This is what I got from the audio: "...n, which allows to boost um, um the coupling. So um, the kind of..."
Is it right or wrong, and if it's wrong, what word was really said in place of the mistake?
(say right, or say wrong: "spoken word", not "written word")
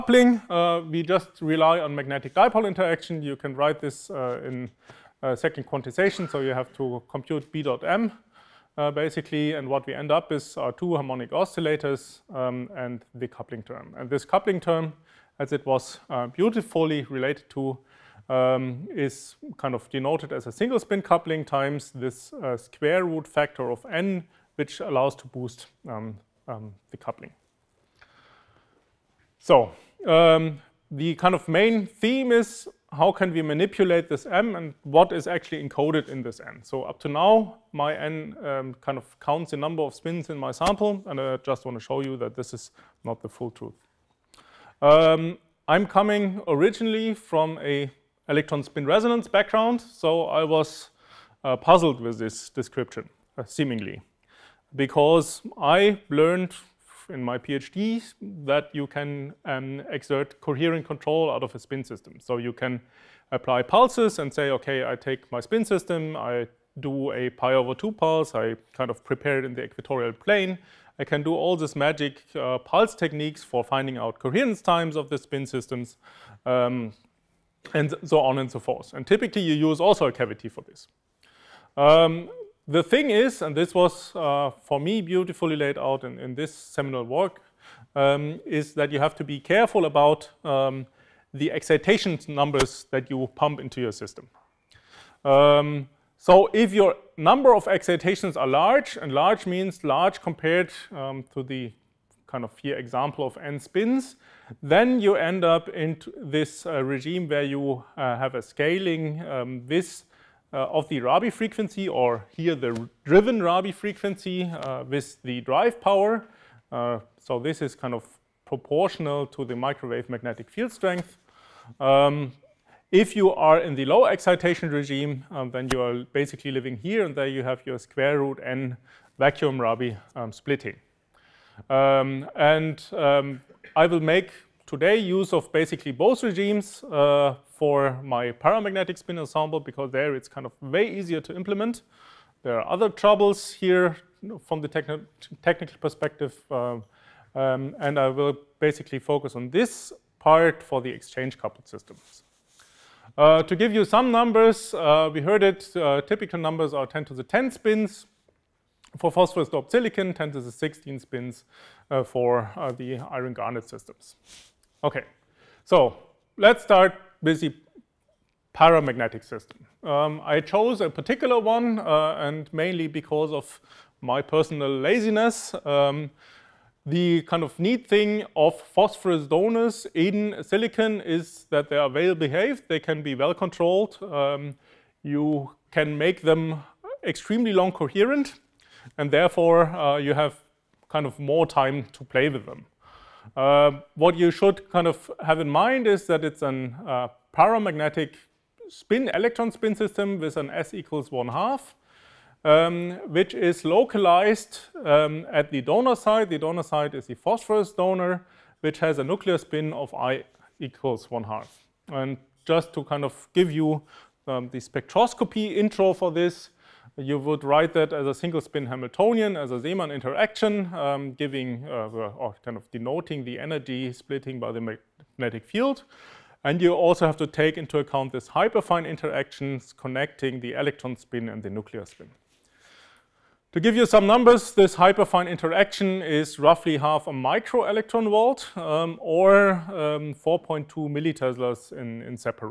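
right.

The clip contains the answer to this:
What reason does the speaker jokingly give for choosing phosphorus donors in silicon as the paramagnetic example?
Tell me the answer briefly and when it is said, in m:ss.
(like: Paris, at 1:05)
Personal laziness, at 2:54.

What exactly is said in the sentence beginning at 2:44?
Okay, so let's start with the paramagnetic system.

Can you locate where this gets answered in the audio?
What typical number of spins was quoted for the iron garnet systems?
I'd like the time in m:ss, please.
2:40.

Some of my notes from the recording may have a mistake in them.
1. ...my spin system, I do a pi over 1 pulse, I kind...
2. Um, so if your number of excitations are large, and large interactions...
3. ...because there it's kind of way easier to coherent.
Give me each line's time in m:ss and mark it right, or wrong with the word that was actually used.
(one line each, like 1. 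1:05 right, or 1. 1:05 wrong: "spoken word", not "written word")
1. 1:05 wrong: "2", not "1"
2. 1:35 wrong: "means", not "interactions"
3. 2:19 wrong: "implement", not "coherent".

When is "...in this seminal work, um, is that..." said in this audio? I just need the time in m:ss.
1:26.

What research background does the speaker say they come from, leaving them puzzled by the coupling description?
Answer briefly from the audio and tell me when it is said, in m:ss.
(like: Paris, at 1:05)
Electron spin resonance, at 0:48.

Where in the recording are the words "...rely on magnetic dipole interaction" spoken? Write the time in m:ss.
0:01.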